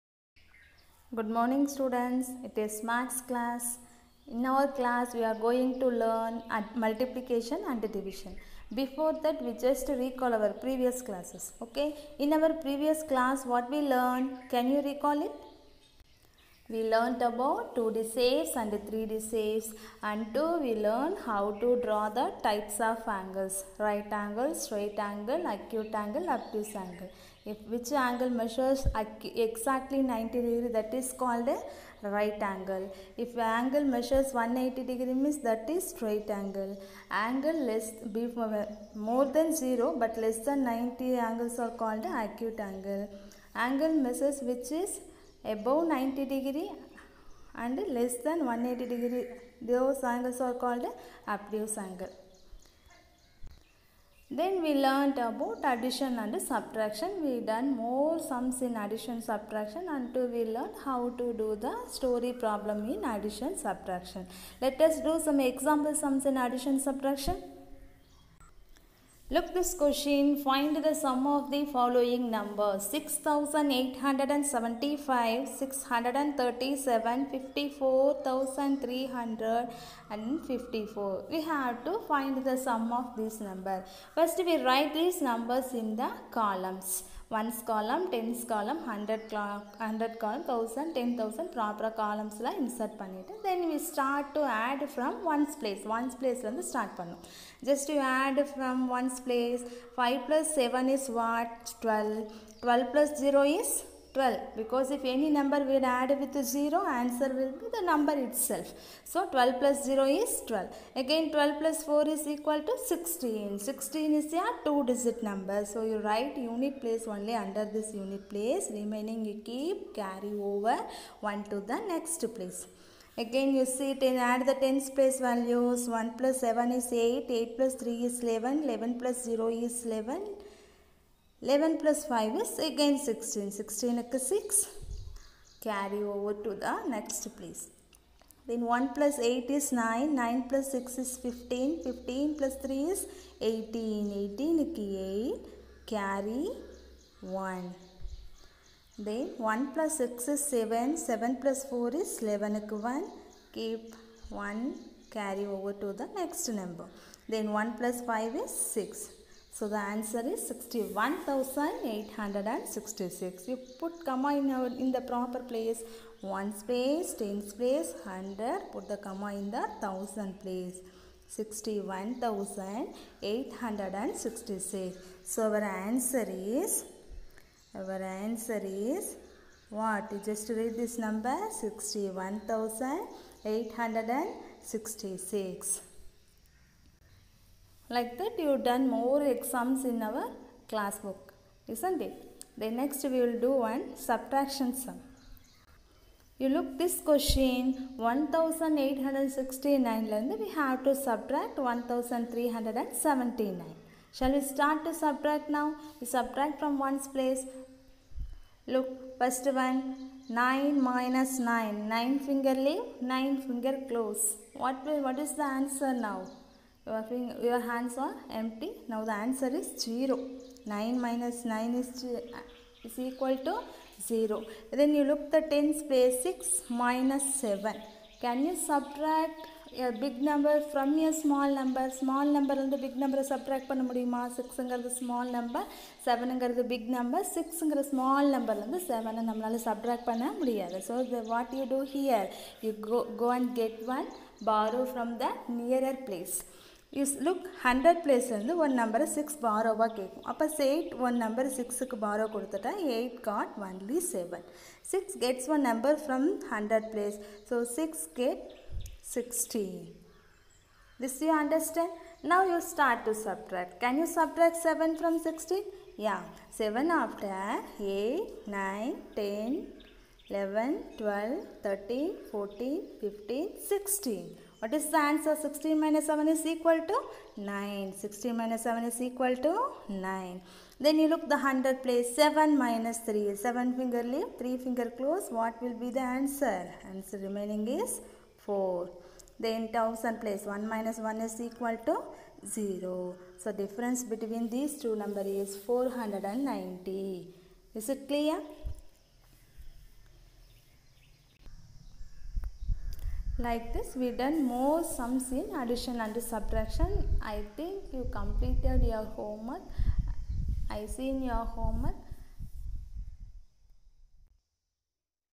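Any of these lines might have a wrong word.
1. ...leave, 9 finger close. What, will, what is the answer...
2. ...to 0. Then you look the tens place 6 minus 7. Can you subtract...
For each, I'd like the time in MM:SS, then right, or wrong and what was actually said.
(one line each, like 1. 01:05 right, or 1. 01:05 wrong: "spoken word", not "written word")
1. 03:32 right
2. 03:43 right.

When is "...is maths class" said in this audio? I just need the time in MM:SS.
00:02.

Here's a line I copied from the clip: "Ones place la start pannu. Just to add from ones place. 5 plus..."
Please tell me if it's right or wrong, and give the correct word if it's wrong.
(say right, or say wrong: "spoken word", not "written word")
right.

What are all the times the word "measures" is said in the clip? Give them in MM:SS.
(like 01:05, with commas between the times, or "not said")
00:28, 00:33, 00:43.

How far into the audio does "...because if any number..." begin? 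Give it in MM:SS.
01:44.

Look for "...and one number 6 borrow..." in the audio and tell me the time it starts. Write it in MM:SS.
04:08.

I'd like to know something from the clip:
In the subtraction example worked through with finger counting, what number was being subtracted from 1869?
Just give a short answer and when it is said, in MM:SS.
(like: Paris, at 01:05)
1379, at 03:21.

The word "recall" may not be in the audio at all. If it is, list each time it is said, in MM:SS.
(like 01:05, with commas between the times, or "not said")
00:09, 00:14.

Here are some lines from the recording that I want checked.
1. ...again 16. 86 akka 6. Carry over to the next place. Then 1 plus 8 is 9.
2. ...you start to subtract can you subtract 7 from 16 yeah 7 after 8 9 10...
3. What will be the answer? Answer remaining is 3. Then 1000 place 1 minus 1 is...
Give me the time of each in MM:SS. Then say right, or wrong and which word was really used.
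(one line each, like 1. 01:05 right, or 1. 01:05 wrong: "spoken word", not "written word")
1. 02:12 wrong: "16", not "86"
2. 04:22 right
3. 04:45 wrong: "4", not "3".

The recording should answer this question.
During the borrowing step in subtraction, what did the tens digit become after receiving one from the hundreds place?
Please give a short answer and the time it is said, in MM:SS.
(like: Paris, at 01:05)
16, at 04:17.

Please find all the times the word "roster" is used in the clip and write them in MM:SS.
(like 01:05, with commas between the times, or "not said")
not said.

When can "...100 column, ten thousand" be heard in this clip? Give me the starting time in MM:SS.
01:29.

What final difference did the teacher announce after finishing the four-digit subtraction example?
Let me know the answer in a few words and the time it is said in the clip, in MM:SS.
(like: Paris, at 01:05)
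490, at 04:55.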